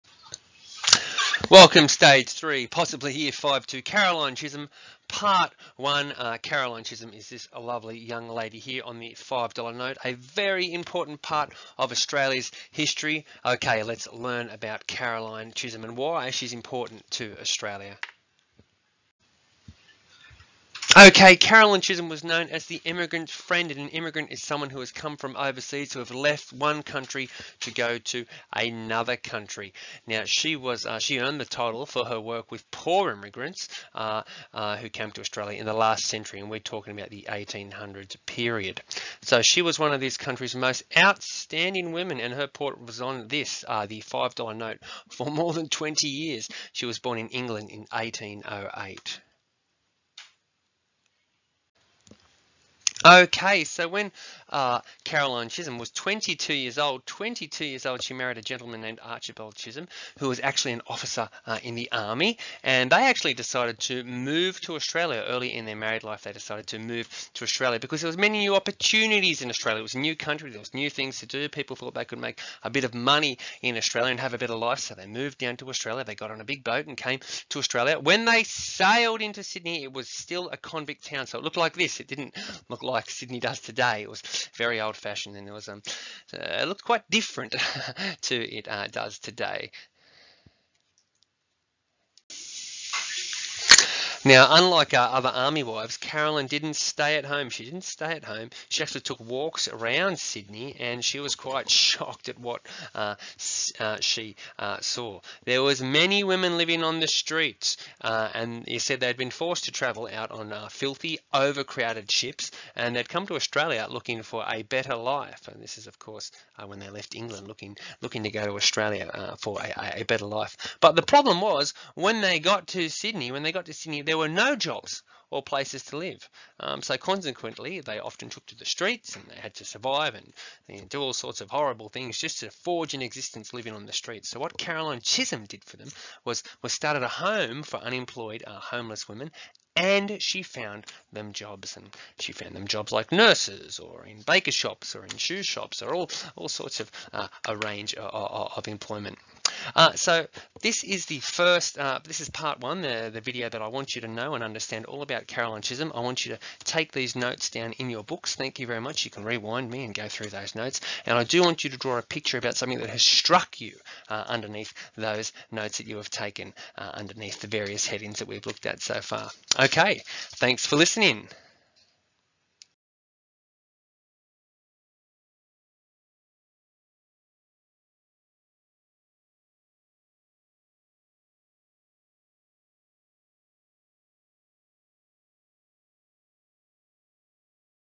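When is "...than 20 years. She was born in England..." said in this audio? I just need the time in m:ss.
0:45.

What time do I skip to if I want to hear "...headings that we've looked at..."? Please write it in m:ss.
2:47.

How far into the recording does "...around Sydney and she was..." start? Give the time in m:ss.
1:39.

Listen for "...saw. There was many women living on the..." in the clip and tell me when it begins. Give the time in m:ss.
1:44.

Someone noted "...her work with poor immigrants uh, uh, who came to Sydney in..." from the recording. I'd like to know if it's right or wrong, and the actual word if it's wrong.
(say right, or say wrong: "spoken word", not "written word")
wrong: "Australia", not "Sydney".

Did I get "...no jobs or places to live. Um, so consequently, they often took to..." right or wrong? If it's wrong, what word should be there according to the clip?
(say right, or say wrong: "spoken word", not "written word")
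right.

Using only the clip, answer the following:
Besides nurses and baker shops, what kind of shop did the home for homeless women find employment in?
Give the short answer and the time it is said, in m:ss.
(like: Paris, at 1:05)
shoe shops, at 2:25.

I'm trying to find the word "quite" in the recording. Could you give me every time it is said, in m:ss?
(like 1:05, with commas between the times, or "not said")
1:26, 1:41.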